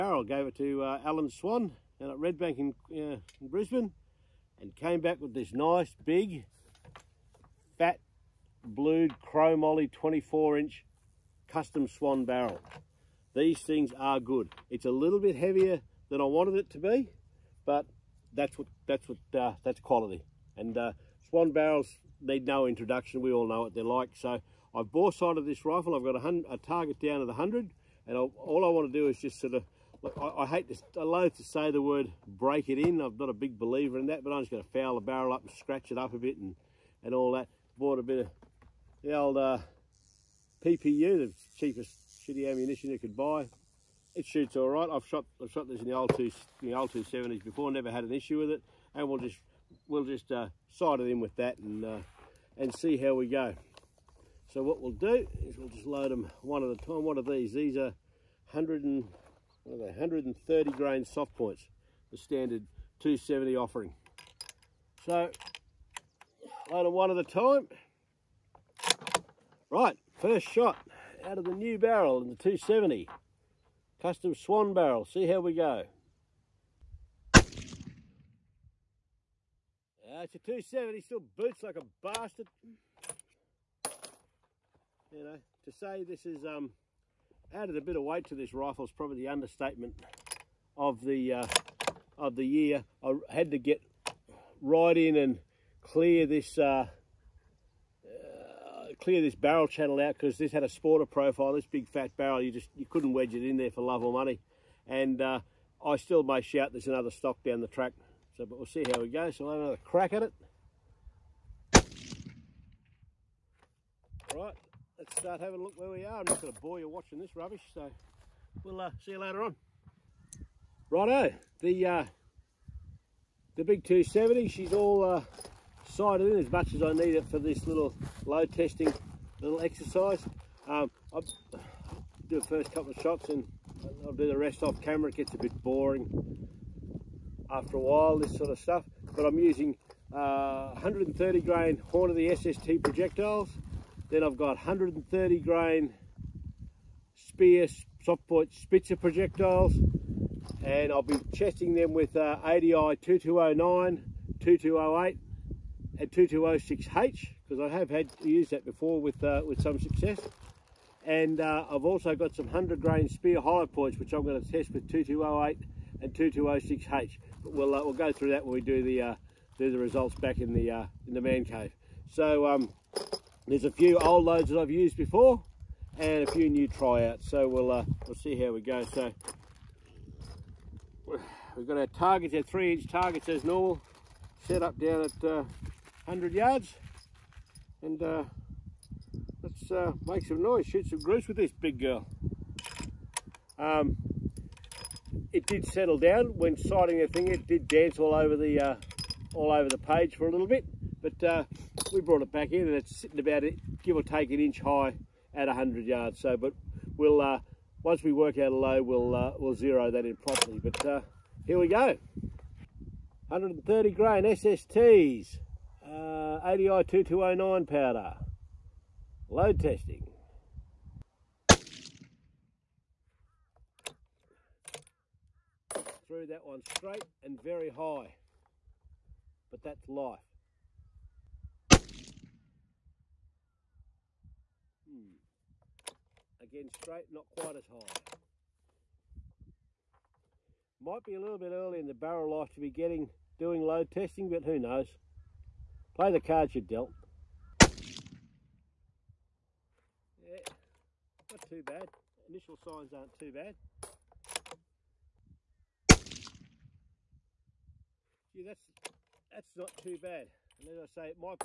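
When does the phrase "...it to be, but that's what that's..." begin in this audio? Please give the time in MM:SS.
00:16.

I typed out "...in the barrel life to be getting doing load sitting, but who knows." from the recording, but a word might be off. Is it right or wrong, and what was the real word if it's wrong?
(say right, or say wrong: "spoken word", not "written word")
wrong: "testing", not "sitting".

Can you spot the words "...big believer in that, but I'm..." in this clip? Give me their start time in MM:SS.
00:33.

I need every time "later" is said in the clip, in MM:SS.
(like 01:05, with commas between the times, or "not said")
01:59.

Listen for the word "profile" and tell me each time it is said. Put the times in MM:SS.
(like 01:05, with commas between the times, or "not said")
01:41.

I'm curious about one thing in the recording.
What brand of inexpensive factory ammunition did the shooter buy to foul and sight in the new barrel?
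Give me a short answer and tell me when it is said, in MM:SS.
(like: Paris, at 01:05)
PPU, at 00:40.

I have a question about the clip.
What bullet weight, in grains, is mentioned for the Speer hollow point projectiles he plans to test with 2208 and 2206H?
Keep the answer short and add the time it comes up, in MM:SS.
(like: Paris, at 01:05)
100, at 02:42.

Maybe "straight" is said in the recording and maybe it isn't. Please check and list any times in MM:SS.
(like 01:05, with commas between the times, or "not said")
03:46, 03:56.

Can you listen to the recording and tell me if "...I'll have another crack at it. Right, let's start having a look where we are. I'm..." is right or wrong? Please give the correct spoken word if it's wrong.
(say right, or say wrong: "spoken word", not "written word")
right.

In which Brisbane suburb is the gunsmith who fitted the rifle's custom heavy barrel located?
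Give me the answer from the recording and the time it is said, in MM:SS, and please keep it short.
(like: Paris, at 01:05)
Red Bank, at 00:02.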